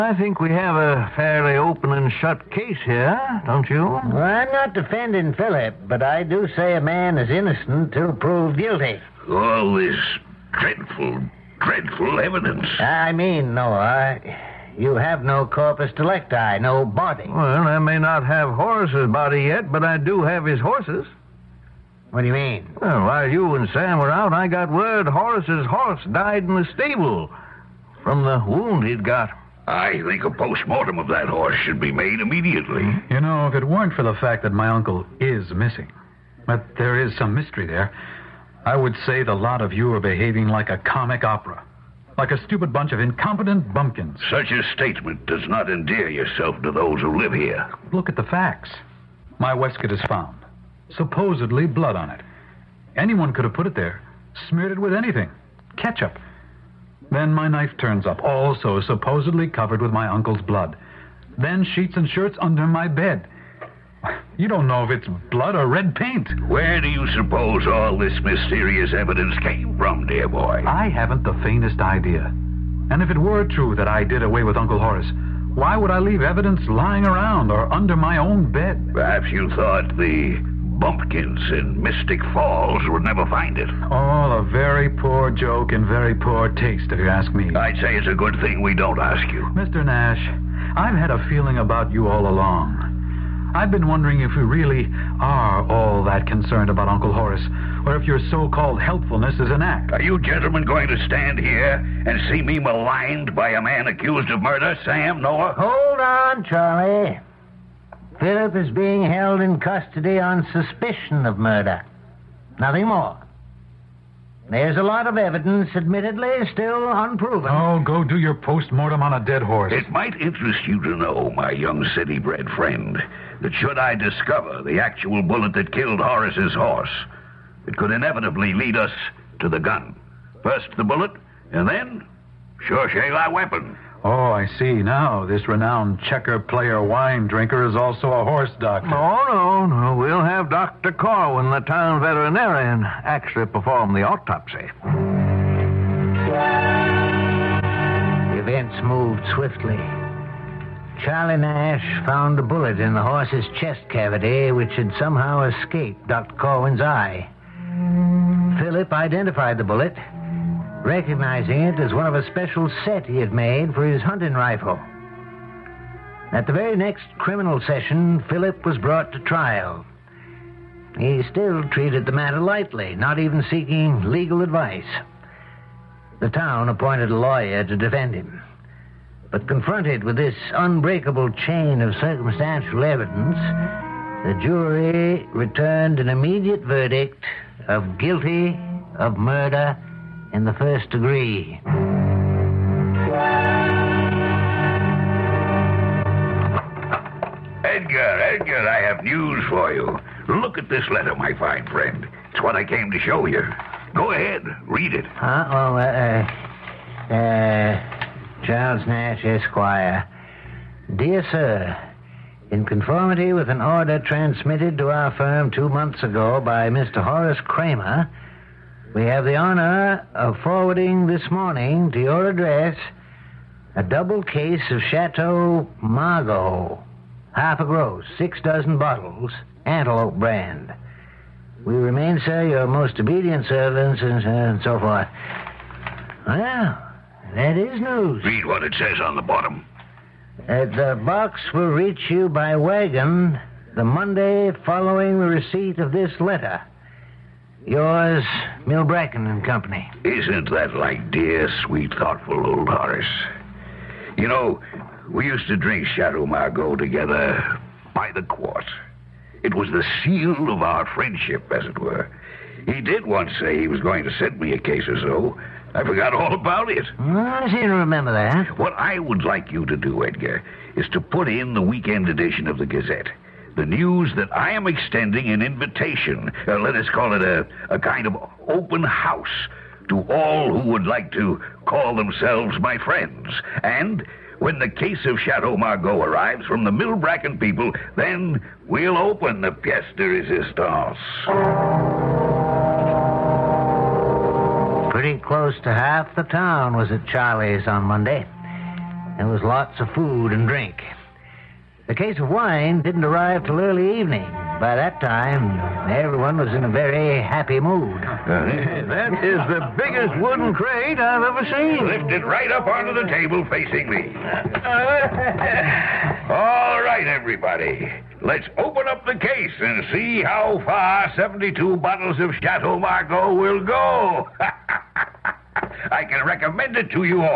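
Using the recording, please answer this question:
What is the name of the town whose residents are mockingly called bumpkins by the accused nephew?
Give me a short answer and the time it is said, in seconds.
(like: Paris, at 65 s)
Mystic Falls, at 81 s.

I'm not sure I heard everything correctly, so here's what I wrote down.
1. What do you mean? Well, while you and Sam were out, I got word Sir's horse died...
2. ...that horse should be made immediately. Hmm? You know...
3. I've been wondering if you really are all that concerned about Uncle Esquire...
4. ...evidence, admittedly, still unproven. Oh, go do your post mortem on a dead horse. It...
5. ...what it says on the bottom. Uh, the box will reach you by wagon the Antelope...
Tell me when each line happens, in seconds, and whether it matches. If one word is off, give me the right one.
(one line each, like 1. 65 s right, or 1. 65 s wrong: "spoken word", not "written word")
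1. 22 s wrong: "Horace", not "Sir"
2. 31 s right
3. 93 s wrong: "Horace", not "Esquire"
4. 115 s right
5. 238 s wrong: "Monday", not "Antelope".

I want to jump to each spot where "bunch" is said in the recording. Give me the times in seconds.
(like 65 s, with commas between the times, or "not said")
42 s.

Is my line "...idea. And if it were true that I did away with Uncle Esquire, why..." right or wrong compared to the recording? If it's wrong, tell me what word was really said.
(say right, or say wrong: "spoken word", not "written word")
wrong: "Horace", not "Esquire".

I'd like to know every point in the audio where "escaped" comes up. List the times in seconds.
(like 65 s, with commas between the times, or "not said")
155 s.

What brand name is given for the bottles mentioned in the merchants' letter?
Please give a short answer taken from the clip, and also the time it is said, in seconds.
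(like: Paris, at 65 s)
Antelope, at 229 s.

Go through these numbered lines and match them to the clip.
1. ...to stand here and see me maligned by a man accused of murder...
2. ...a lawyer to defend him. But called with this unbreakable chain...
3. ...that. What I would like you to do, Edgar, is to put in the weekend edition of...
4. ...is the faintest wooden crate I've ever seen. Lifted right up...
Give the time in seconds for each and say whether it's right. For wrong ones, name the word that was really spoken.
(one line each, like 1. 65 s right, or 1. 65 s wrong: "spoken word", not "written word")
1. 100 s right
2. 177 s wrong: "confronted", not "called"
3. 268 s right
4. 309 s wrong: "biggest", not "faintest".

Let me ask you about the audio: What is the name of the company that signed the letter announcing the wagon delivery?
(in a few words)
Mill Bracken and Company.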